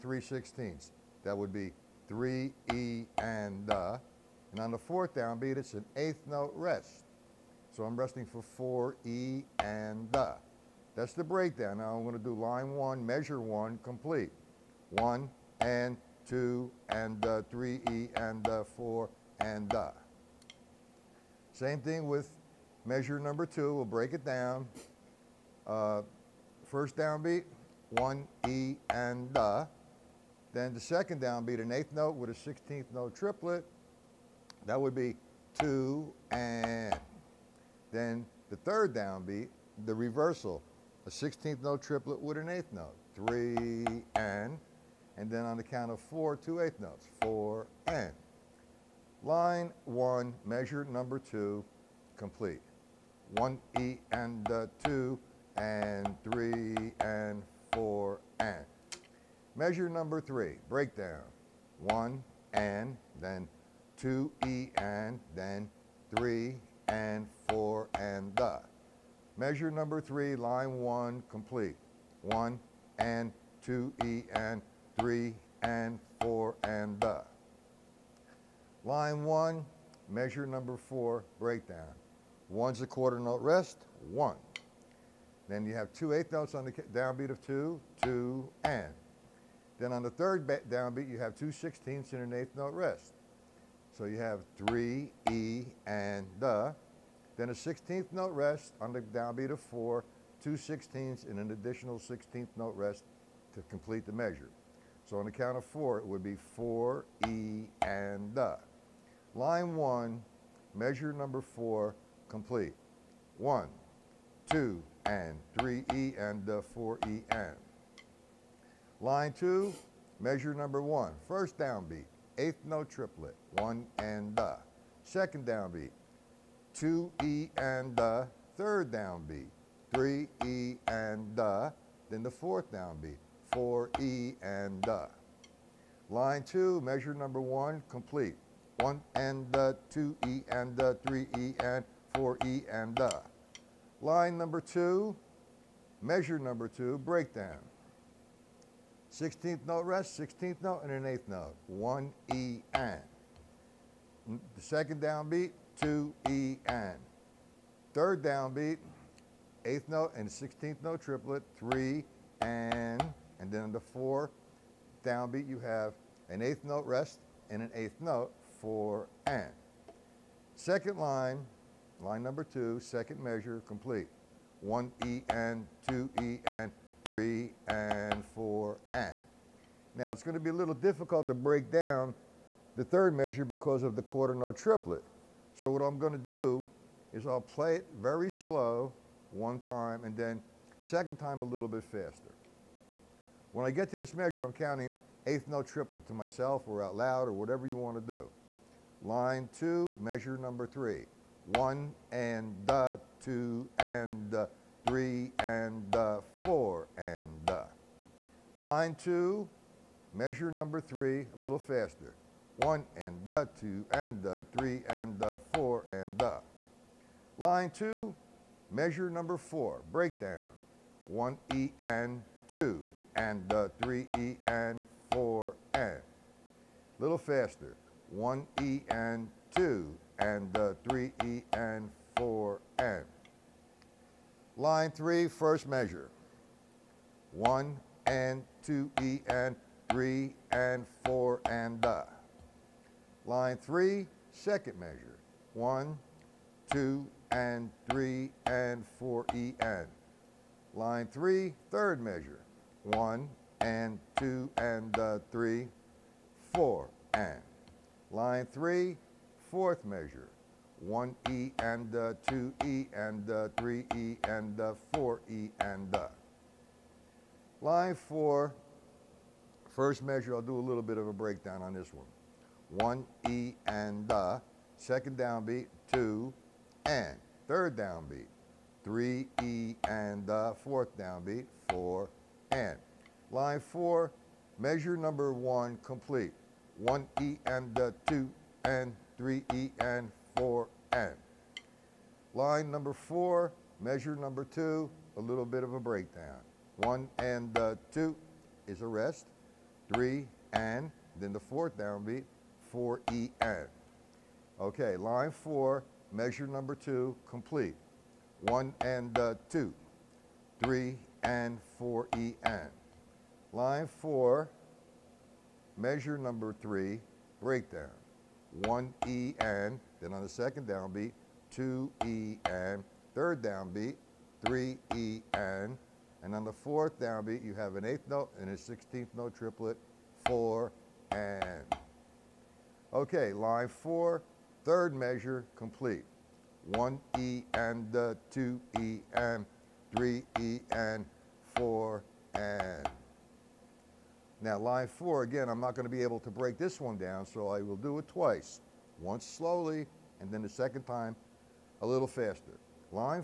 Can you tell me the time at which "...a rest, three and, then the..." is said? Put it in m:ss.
4:58.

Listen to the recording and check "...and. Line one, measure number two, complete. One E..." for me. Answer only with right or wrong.
right.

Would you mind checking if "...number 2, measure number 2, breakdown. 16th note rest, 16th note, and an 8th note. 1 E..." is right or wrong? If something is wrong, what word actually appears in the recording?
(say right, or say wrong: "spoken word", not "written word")
right.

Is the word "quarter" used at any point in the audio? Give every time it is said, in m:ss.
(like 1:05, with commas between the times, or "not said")
1:22, 3:04.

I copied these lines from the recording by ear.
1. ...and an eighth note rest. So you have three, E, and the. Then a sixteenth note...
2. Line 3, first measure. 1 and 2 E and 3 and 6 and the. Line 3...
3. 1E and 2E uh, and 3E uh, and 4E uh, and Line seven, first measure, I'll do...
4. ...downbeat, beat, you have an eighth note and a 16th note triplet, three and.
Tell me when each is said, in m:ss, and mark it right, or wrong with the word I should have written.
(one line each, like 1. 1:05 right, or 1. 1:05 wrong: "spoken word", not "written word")
1. 1:32 right
2. 3:54 wrong: "4", not "6"
3. 4:20 wrong: "four", not "seven"
4. 5:27 wrong: "four", not "three".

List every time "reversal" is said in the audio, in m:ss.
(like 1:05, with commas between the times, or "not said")
0:39.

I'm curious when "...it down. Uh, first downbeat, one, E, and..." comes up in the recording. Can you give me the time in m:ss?
0:24.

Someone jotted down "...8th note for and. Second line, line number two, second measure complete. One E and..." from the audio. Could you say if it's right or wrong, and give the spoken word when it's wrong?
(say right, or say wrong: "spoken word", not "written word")
right.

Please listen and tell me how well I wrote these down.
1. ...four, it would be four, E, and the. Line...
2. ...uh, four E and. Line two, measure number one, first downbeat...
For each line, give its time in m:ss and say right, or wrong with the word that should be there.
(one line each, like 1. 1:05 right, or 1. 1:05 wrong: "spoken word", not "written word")
1. 1:45 right
2. 1:56 right.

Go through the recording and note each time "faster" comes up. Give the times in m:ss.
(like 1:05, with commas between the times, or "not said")
3:11, 3:31, 3:47, 5:52.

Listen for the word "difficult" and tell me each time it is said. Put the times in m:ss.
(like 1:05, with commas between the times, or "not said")
3:00.